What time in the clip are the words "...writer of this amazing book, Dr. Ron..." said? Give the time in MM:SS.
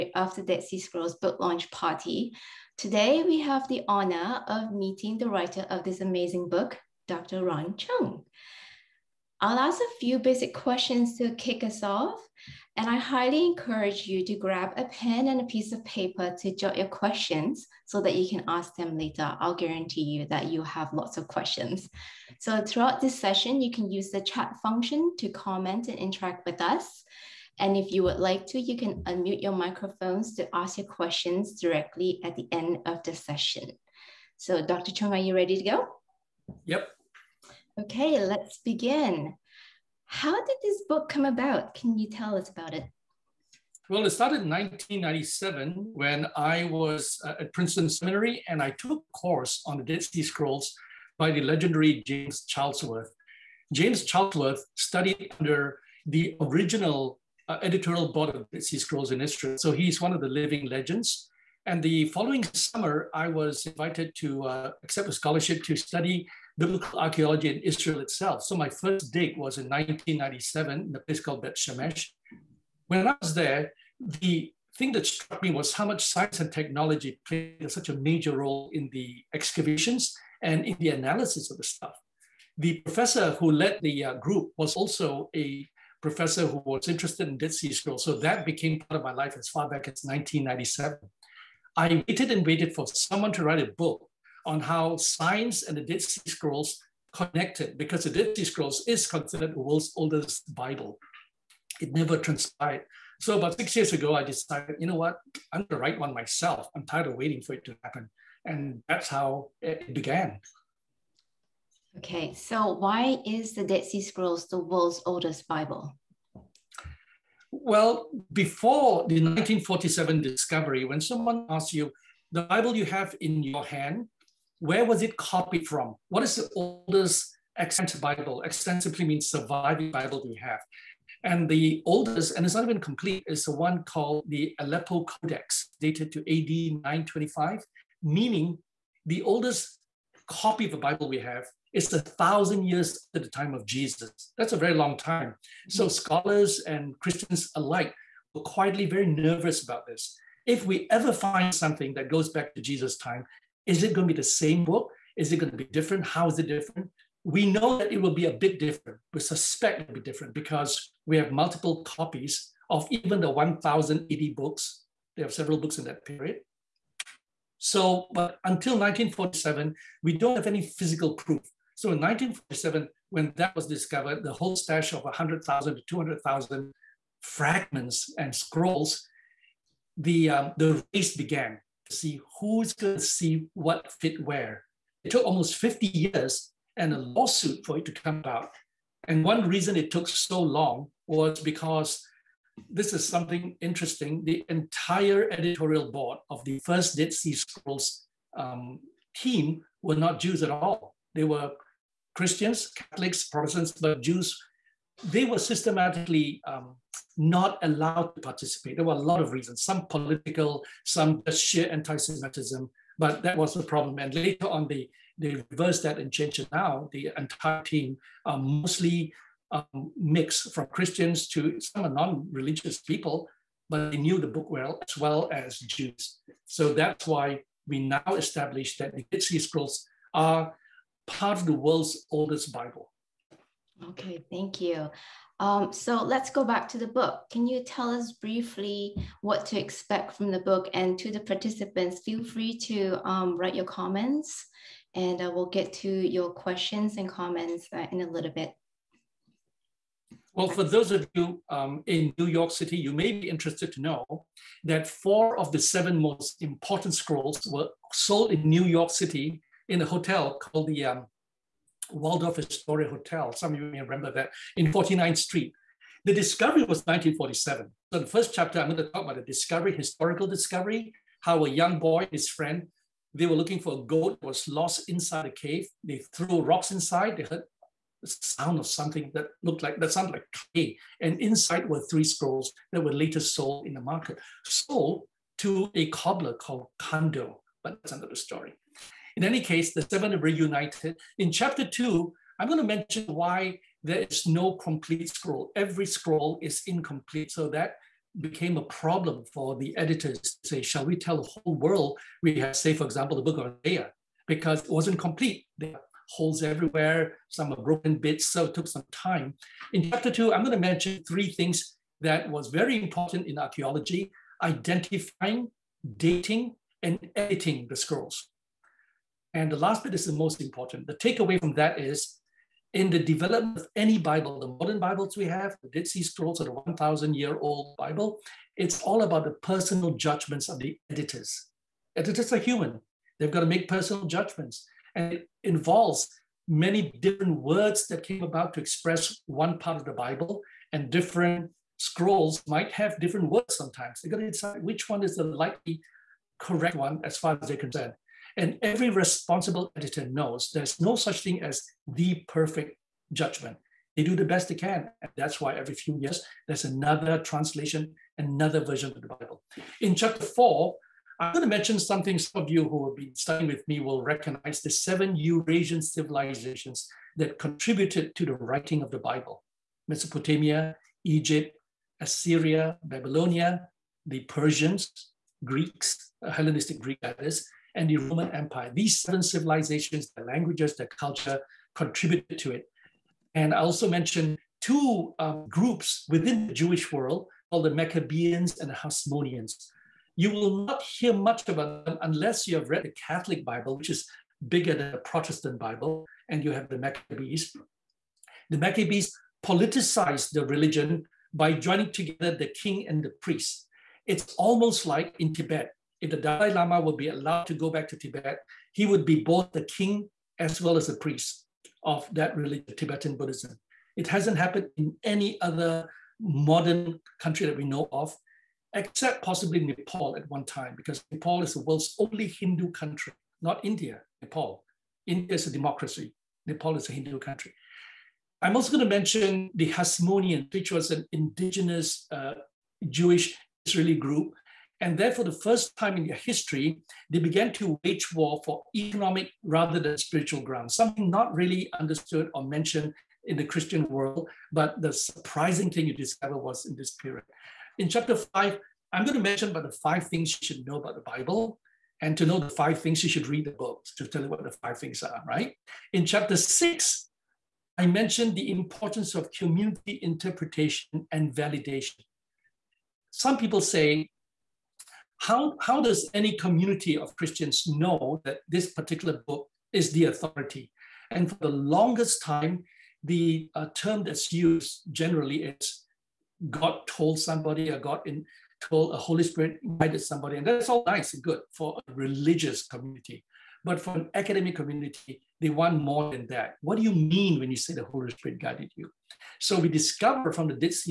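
00:05.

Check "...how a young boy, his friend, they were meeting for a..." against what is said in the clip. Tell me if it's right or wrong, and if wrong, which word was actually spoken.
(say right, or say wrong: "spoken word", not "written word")
wrong: "looking", not "meeting".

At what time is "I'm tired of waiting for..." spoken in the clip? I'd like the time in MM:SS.
01:46.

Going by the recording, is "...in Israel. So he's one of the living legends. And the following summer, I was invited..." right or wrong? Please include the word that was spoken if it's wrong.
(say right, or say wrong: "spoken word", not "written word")
right.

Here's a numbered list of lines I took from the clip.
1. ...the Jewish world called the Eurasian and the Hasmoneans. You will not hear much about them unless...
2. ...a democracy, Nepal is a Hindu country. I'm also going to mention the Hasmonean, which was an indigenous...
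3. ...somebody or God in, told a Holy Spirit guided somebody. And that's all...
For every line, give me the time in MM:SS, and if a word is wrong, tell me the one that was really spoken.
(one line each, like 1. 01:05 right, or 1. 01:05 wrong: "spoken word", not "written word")
1. 06:26 wrong: "Maccabeans", not "Eurasian"
2. 07:05 right
3. 07:57 right.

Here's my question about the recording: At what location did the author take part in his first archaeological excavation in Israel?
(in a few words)
Bet Shemesh.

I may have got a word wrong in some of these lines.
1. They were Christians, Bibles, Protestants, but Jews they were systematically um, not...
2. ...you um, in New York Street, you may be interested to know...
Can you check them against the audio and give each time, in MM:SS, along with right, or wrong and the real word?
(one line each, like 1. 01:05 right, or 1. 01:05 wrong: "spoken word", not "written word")
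1. 03:21 wrong: "Catholics", not "Bibles"
2. 04:11 wrong: "City", not "Street".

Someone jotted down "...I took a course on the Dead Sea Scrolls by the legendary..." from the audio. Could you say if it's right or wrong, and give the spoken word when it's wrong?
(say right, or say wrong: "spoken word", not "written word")
right.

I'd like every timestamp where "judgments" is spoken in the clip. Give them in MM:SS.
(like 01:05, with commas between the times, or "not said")
05:29, 05:34, 05:53.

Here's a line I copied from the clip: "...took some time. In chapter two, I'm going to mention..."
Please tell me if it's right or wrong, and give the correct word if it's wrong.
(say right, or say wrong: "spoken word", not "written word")
right.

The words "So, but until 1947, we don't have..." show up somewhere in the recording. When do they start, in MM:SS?
02:47.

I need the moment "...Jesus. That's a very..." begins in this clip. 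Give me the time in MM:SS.
02:23.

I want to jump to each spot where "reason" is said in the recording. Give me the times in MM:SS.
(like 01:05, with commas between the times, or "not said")
03:09, 03:29.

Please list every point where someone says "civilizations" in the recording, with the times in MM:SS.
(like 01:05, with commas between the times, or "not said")
06:05, 06:19.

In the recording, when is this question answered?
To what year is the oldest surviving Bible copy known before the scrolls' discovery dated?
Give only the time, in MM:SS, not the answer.
02:16.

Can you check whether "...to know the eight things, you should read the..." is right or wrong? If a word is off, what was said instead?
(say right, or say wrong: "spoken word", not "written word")
wrong: "five", not "eight".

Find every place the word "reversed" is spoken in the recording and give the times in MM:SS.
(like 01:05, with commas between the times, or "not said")
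03:35.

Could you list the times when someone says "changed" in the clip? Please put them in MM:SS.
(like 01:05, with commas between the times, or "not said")
03:36.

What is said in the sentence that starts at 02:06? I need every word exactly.
What is the oldest extant Bible?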